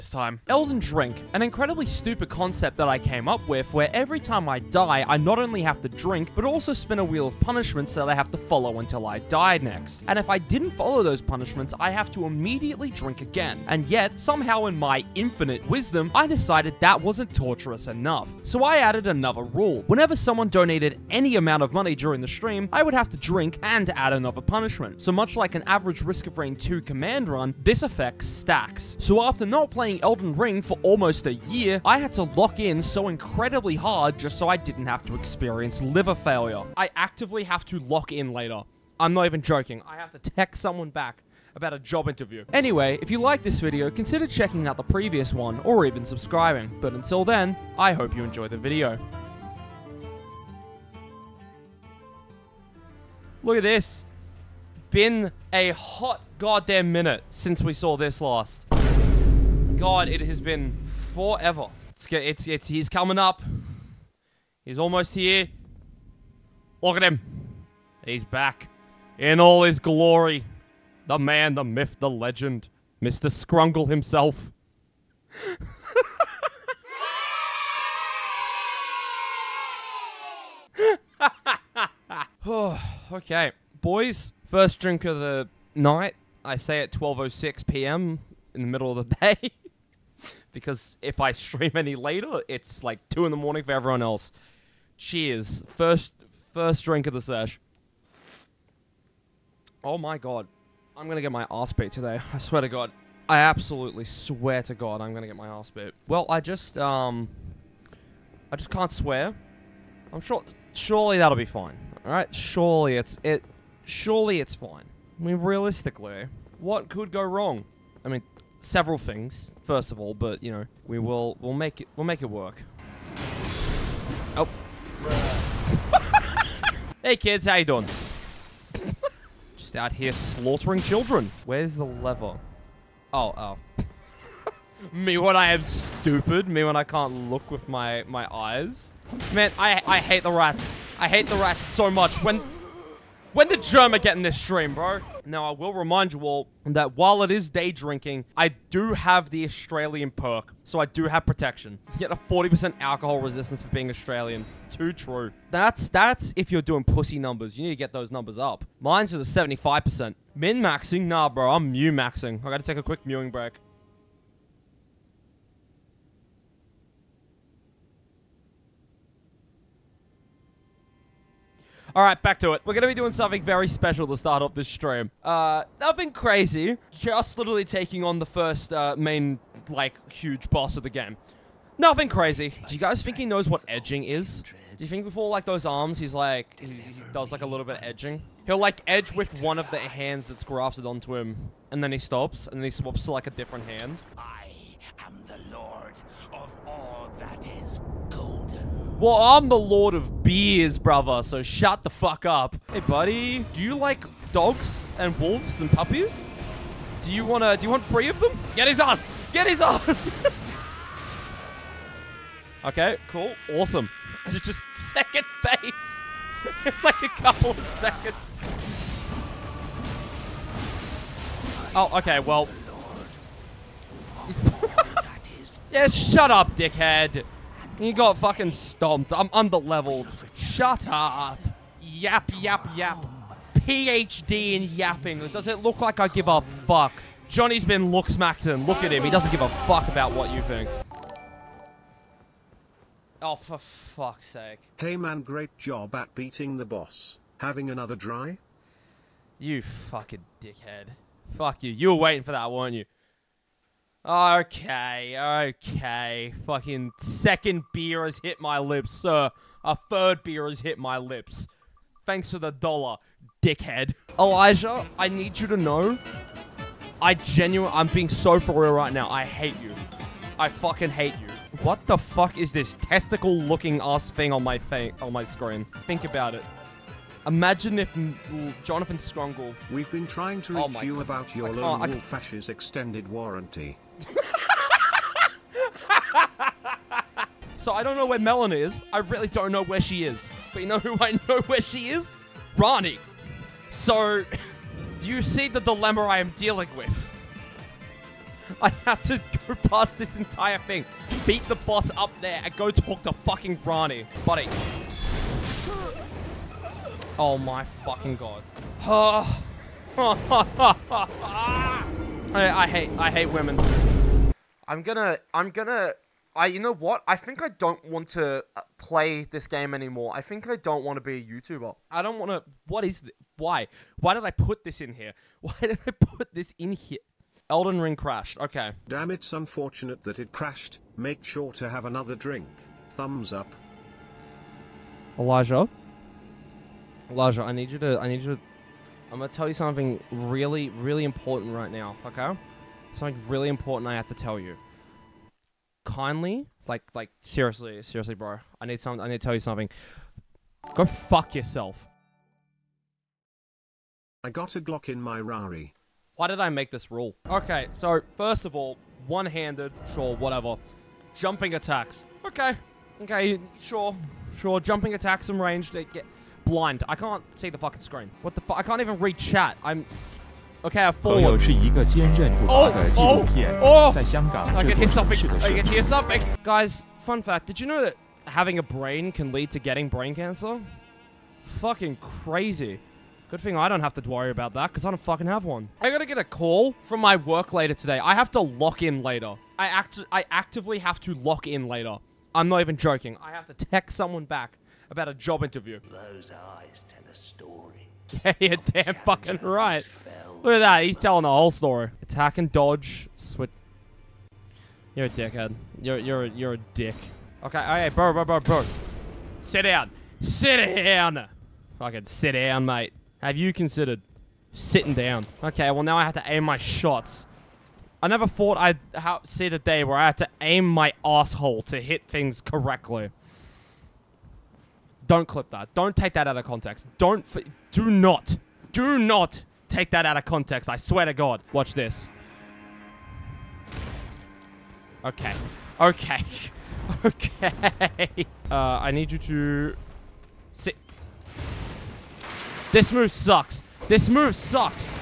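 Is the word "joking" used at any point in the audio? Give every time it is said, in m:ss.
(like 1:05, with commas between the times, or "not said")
0:39, 6:32.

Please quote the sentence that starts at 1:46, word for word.
Well, I just um, I just can't swear.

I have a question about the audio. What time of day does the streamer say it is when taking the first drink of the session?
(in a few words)
12:06 p.m.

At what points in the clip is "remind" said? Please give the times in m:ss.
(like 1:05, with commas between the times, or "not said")
2:25.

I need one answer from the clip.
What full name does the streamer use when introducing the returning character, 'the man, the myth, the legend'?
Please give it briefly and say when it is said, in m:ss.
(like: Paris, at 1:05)
Mr. Scrungle, at 1:13.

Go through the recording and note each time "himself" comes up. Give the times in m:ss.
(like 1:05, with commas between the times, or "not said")
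1:13.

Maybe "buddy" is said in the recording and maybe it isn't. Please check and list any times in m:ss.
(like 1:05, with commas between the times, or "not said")
3:22, 5:04.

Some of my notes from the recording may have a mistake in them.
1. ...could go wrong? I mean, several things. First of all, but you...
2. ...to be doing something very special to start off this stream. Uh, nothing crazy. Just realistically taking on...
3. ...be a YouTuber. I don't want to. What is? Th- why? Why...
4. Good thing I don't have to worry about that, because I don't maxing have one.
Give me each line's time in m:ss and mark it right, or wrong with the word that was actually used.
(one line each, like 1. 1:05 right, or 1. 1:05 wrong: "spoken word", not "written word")
1. 1:56 right
2. 2:52 wrong: "literally", not "realistically"
3. 5:21 right
4. 6:23 wrong: "fucking", not "maxing".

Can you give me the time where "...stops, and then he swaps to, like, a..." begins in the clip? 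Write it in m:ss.
3:11.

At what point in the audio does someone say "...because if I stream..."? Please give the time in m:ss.
1:30.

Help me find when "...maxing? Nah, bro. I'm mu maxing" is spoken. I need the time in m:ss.
2:40.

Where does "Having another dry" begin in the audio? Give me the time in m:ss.
4:07.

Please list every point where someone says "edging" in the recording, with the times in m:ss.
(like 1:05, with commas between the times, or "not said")
3:03, 3:07.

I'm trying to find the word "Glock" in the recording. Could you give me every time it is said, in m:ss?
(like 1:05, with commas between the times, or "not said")
5:54.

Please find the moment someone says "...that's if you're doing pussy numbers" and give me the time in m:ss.
2:35.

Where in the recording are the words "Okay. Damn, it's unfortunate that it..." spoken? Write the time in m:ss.
5:28.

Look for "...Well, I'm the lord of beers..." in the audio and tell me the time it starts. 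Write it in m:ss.
3:18.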